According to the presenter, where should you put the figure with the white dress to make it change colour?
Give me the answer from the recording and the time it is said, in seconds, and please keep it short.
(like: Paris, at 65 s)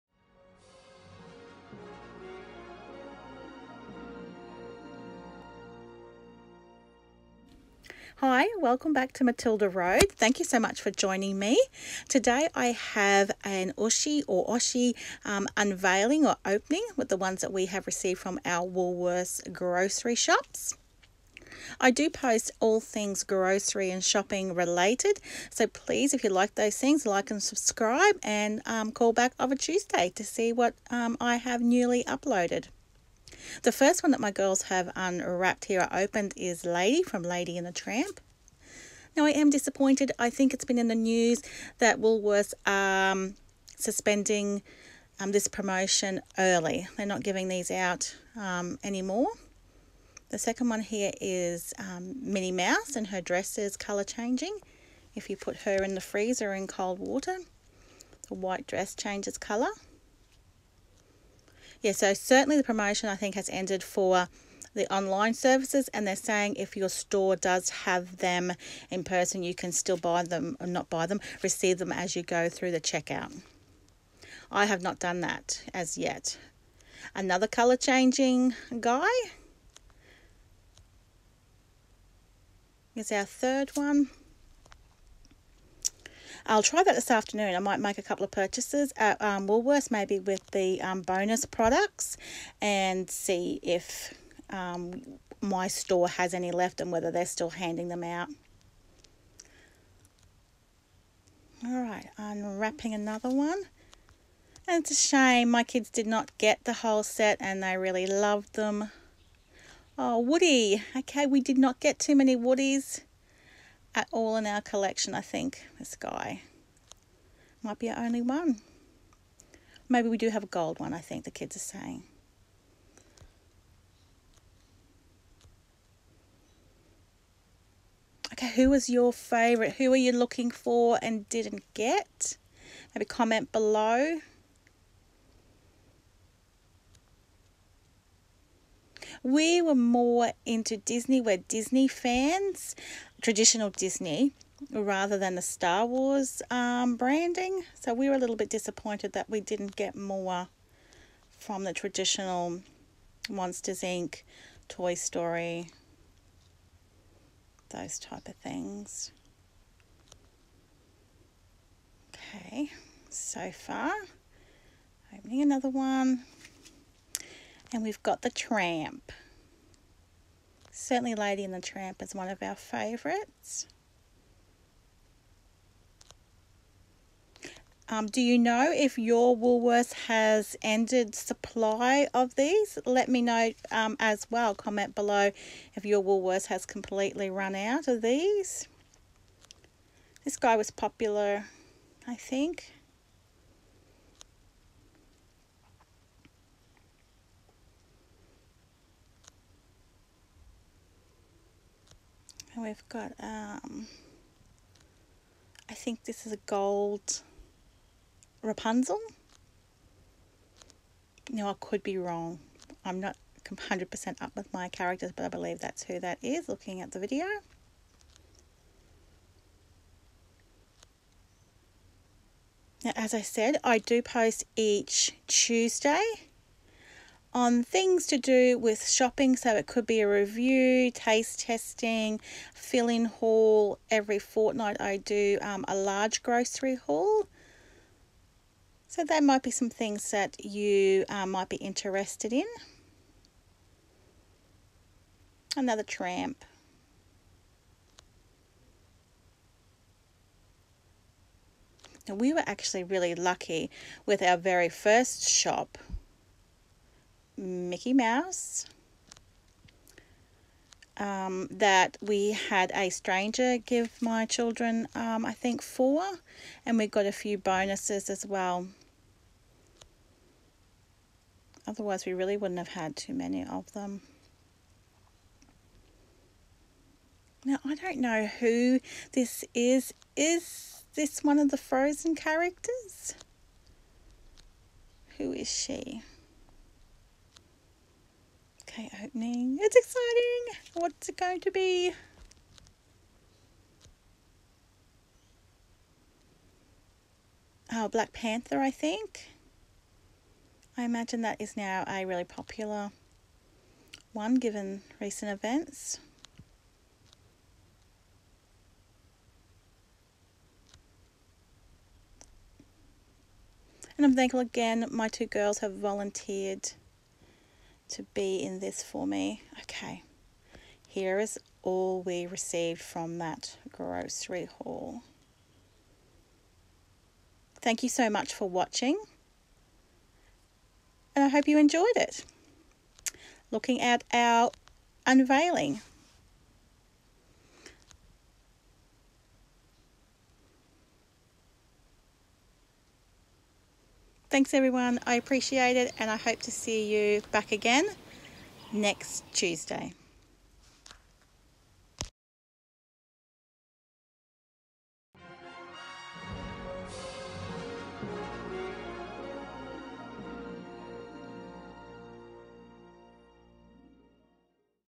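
In the freezer, at 55 s.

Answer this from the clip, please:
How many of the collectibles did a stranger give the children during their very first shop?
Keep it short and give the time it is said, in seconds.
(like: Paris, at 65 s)
4, at 265 s.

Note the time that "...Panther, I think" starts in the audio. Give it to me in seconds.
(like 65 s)
298 s.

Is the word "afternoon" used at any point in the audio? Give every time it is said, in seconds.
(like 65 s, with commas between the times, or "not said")
87 s.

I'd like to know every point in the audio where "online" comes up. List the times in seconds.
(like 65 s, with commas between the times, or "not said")
64 s.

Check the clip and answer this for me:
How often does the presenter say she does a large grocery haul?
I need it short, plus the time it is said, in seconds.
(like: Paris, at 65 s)
Every fortnight, at 233 s.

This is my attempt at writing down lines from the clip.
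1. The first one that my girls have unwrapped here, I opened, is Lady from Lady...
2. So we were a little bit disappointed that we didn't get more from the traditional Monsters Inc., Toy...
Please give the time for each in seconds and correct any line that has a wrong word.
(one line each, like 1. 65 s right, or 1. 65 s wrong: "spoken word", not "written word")
1. 33 s right
2. 147 s right.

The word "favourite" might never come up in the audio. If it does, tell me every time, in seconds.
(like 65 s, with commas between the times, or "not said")
129 s, 172 s.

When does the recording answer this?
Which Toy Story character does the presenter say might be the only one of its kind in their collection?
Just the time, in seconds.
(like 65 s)
110 s.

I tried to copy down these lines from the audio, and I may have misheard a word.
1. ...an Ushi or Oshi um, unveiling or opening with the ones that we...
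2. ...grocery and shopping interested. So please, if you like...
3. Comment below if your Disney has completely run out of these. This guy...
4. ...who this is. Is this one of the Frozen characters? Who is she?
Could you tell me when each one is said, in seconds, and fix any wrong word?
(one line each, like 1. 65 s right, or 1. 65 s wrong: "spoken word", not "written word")
1. 13 s right
2. 23 s wrong: "related", not "interested"
3. 184 s wrong: "Woolworths", not "Disney"
4. 278 s right.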